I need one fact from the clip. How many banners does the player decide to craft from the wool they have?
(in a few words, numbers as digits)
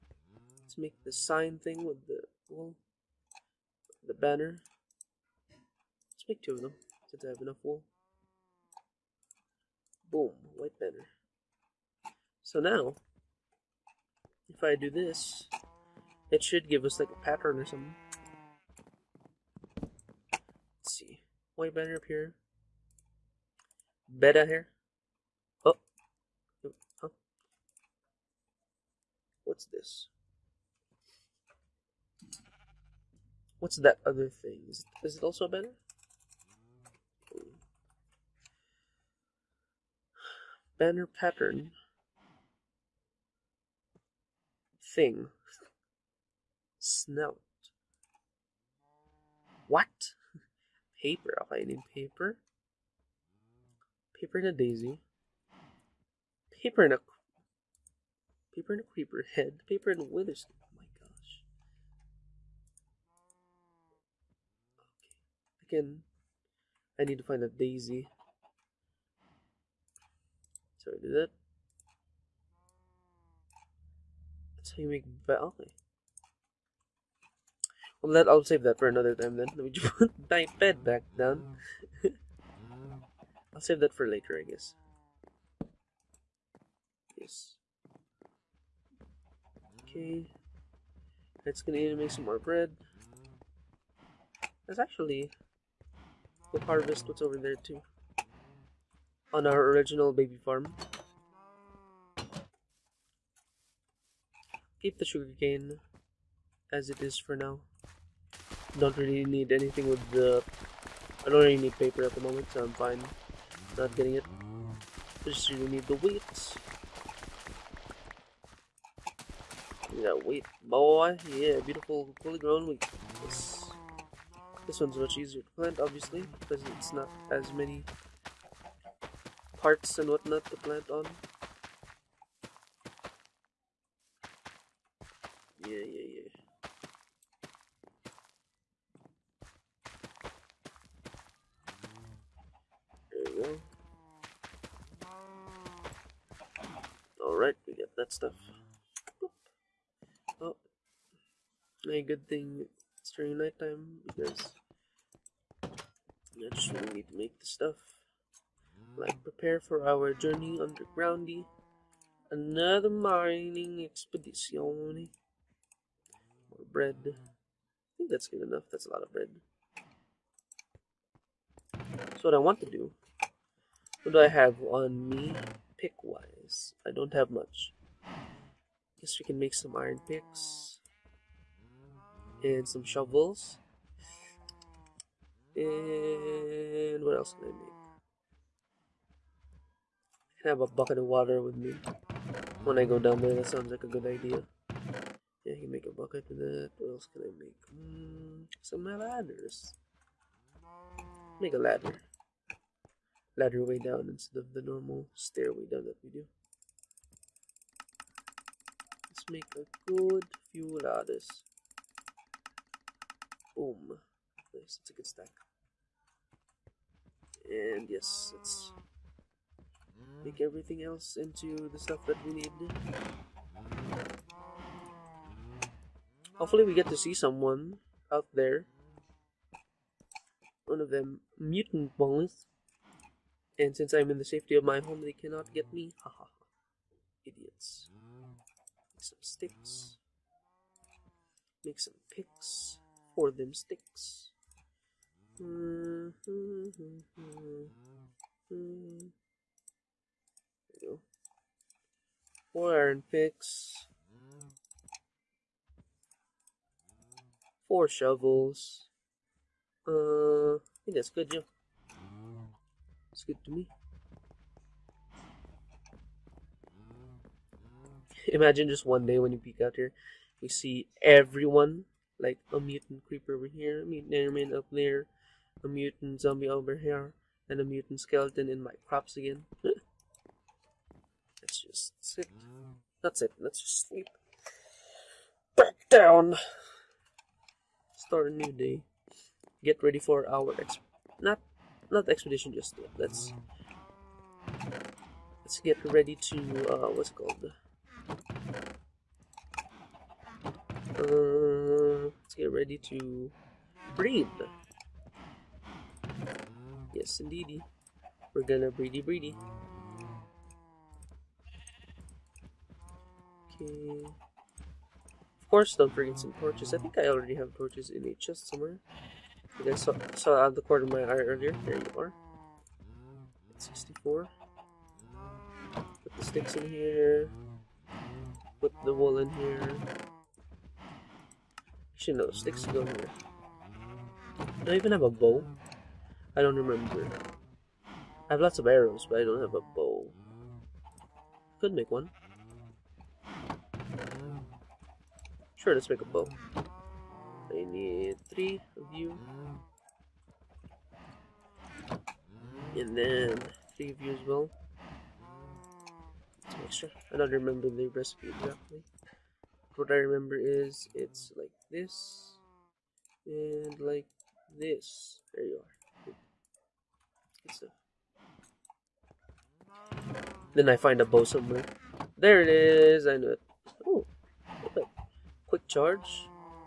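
2.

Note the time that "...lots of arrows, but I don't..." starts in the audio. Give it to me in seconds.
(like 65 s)
338 s.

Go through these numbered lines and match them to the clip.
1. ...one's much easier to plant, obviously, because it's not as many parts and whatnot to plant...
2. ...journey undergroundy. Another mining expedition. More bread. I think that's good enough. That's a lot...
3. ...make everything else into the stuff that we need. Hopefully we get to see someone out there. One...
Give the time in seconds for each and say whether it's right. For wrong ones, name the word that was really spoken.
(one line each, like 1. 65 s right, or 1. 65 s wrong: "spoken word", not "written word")
1. 124 s right
2. 160 s right
3. 220 s right.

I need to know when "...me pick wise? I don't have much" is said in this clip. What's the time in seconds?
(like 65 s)
175 s.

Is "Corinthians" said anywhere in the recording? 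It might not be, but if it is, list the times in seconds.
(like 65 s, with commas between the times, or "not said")
not said.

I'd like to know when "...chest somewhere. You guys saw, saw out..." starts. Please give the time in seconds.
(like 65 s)
318 s.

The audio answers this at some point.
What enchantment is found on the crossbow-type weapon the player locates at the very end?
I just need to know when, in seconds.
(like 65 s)
375 s.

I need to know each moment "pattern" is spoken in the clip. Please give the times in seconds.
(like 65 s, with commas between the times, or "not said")
17 s, 41 s.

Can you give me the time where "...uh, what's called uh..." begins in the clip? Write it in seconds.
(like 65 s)
296 s.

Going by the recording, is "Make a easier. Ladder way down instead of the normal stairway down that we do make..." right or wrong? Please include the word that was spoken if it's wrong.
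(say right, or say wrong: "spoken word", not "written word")
wrong: "ladder", not "easier".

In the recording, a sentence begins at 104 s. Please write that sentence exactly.
Keep the sugarcane as it is for now don't really need anything with the...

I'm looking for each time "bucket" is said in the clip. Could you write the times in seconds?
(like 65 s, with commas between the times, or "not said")
190 s, 195 s.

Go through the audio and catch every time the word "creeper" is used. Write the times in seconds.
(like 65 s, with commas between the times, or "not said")
58 s, 273 s.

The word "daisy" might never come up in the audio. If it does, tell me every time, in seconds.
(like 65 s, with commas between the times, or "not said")
54 s, 67 s.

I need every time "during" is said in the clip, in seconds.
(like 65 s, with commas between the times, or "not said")
153 s.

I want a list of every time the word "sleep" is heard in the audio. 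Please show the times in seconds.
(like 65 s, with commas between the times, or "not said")
283 s.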